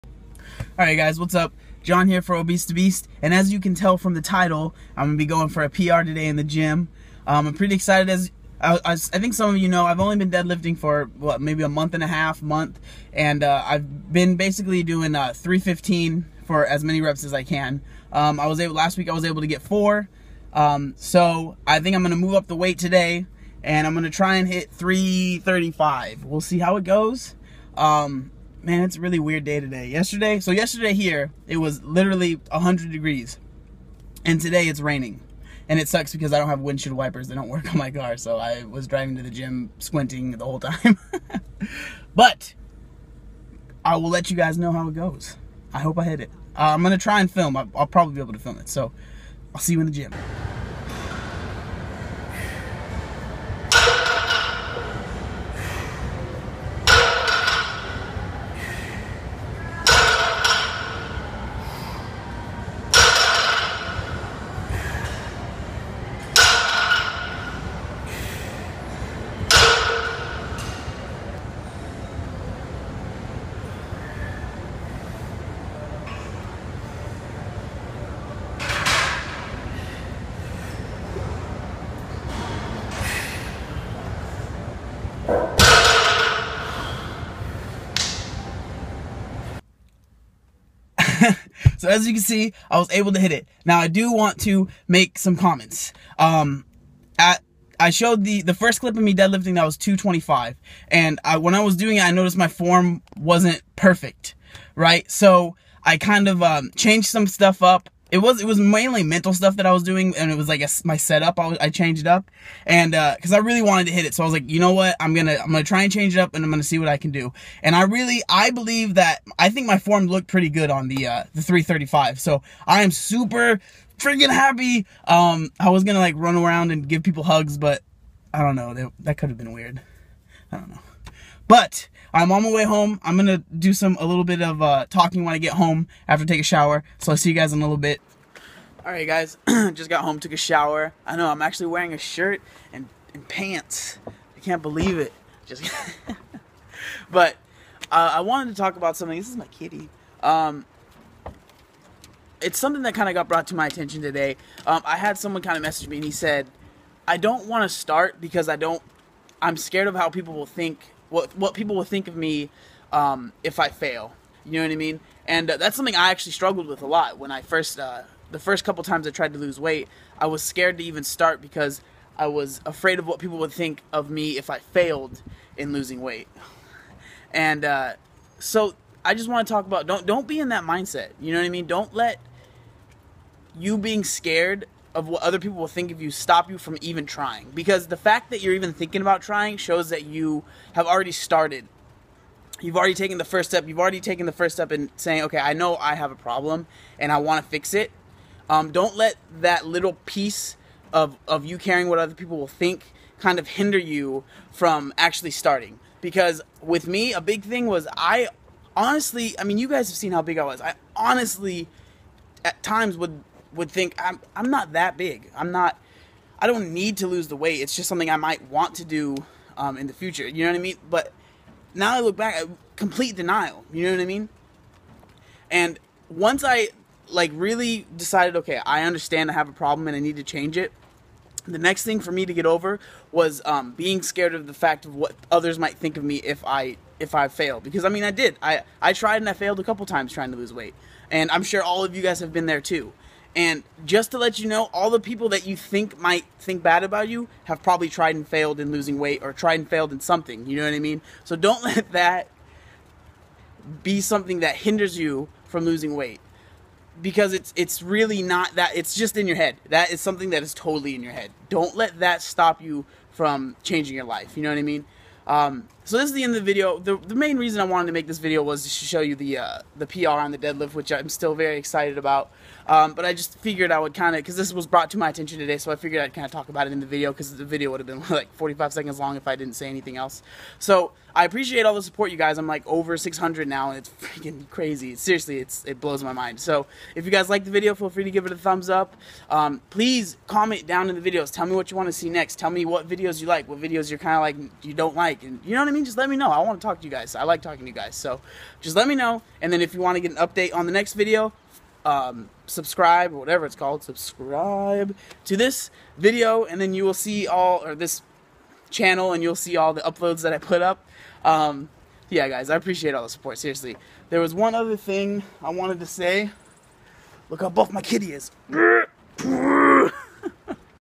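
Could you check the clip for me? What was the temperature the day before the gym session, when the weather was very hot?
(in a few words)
100 degrees.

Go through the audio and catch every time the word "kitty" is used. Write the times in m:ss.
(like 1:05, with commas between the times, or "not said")
2:29, 5:17.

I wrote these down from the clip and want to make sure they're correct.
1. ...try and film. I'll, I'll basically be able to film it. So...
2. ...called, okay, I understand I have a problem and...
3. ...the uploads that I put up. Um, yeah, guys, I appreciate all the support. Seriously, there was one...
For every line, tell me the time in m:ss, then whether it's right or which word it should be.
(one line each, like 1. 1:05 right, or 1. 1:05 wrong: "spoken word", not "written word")
1. 0:47 wrong: "probably", not "basically"
2. 3:47 wrong: "decided", not "called"
3. 5:09 right.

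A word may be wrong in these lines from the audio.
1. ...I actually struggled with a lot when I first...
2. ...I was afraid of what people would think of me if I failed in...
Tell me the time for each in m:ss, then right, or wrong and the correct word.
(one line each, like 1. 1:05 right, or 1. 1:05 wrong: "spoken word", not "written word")
1. 2:45 right
2. 2:52 right.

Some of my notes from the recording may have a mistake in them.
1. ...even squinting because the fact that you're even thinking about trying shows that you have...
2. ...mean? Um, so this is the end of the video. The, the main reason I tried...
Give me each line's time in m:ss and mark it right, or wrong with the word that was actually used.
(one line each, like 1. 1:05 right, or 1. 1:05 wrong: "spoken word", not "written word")
1. 3:06 wrong: "trying", not "squinting"
2. 4:24 wrong: "wanted", not "tried".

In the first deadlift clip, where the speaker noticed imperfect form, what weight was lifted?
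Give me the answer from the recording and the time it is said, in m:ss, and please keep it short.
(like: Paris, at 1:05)
225, at 1:39.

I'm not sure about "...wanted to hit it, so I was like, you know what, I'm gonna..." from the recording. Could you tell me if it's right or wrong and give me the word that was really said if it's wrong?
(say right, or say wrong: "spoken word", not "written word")
right.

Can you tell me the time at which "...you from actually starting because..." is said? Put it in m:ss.
3:23.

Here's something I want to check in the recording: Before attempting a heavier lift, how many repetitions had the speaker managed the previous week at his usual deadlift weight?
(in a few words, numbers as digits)
4.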